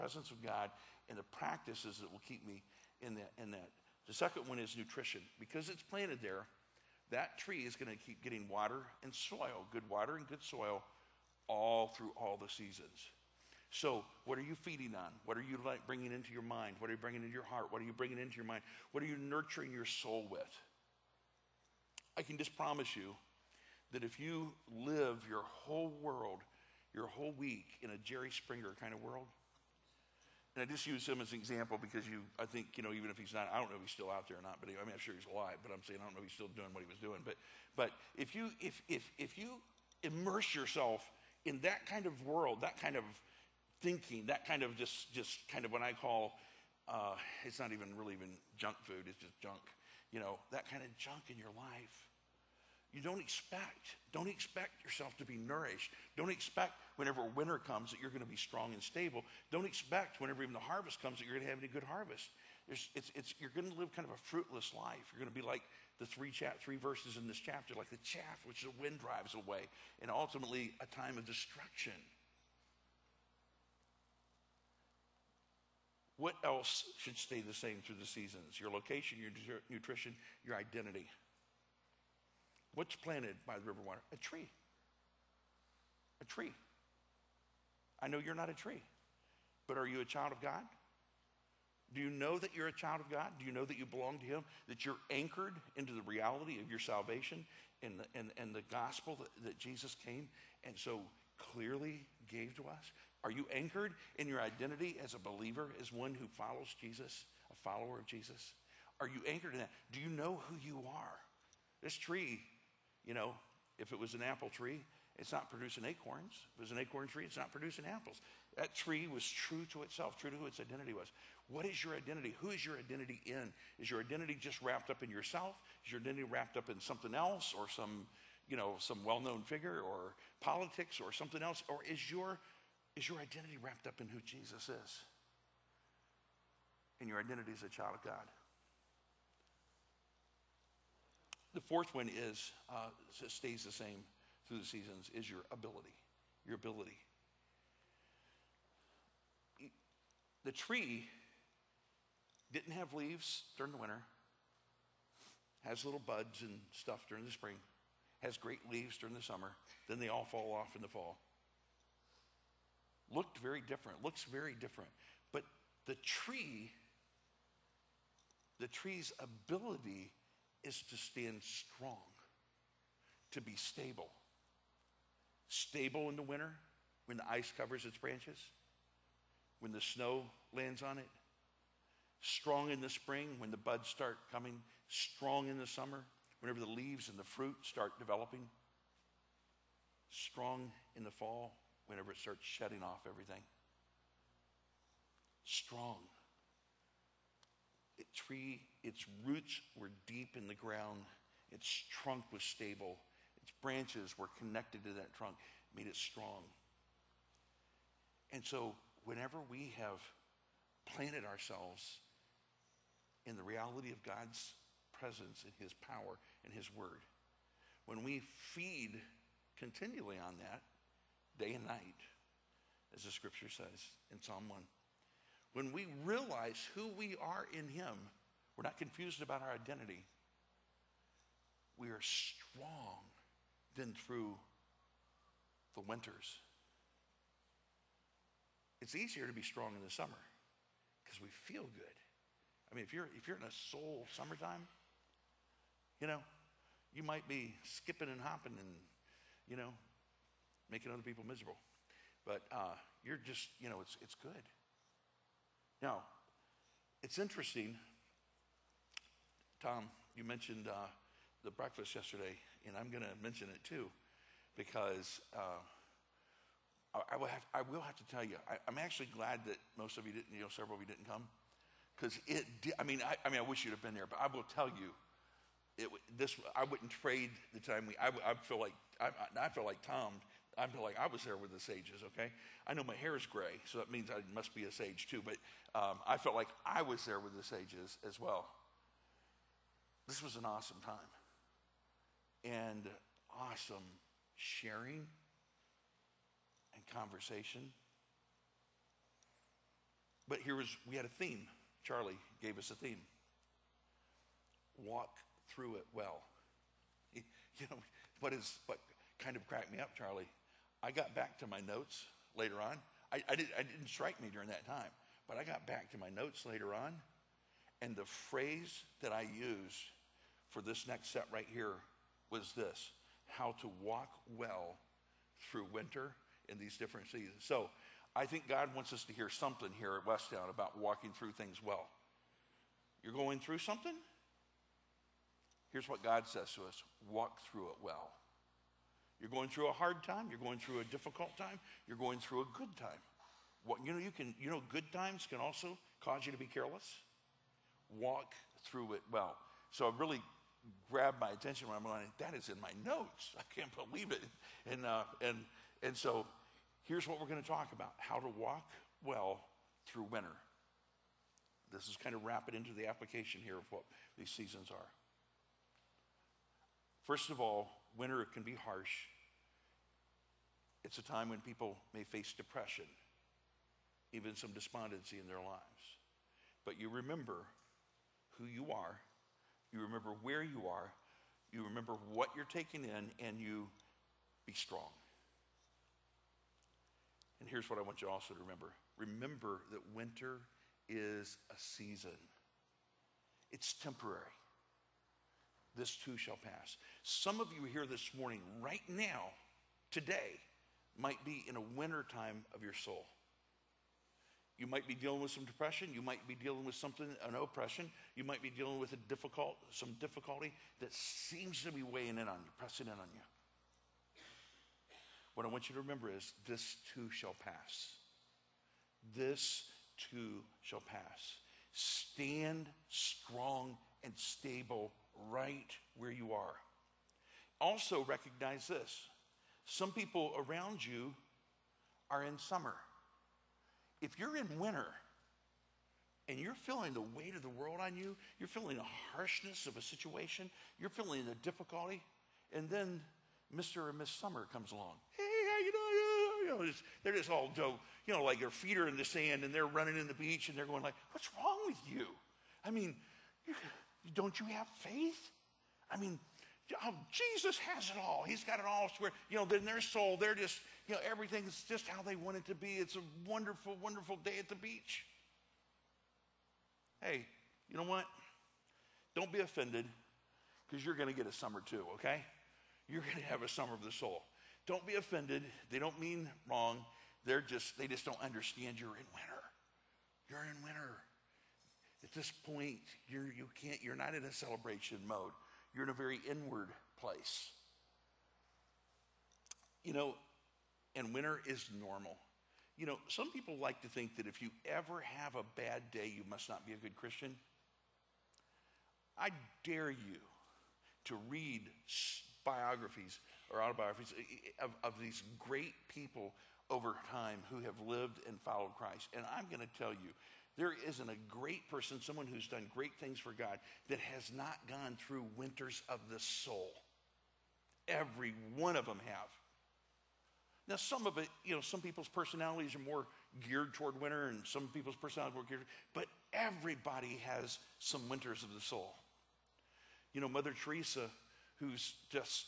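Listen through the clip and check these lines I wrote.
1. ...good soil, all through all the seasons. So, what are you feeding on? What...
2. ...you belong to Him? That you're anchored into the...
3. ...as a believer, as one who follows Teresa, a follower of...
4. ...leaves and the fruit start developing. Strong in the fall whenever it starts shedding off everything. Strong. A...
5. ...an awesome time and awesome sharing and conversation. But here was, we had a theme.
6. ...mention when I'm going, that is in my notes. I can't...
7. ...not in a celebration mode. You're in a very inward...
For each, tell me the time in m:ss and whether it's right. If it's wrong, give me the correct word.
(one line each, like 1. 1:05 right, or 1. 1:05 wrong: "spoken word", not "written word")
1. 0:10 right
2. 1:33 right
3. 1:45 wrong: "Jesus", not "Teresa"
4. 3:06 right
5. 4:50 right
6. 5:51 wrong: "attention", not "mention"
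7. 8:03 right.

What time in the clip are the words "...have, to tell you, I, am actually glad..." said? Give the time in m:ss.
4:27.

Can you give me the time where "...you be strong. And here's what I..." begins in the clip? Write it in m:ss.
6:23.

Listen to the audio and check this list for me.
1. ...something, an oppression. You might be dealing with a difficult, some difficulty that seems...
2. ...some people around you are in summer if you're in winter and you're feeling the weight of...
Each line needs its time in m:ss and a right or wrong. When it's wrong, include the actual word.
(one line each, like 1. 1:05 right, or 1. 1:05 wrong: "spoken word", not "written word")
1. 6:46 right
2. 7:09 right.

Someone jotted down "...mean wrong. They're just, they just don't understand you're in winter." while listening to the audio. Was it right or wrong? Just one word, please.
right.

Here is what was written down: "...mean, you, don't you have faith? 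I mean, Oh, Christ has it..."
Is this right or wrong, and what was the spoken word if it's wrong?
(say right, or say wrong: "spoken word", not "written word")
wrong: "Jesus", not "Christ".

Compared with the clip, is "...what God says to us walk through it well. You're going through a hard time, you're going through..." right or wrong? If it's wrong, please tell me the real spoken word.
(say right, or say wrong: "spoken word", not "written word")
right.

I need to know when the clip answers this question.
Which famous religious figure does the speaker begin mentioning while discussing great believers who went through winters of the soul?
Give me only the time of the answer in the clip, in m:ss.
8:50.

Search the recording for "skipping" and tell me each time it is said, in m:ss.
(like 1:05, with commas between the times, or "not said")
4:07.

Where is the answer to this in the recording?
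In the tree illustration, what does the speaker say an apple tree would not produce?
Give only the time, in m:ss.
1:55.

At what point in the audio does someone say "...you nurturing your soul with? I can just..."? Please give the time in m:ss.
0:19.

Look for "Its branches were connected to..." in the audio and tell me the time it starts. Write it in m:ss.
3:23.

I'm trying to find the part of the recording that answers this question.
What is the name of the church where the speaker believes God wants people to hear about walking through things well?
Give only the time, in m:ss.
5:30.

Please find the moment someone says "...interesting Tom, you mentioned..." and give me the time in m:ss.
4:17.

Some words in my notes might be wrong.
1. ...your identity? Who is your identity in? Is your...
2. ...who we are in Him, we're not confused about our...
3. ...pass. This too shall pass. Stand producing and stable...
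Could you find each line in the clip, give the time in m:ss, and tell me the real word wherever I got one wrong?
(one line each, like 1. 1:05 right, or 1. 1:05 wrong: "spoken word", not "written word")
1. 2:01 right
2. 3:46 right
3. 6:57 wrong: "strong", not "producing".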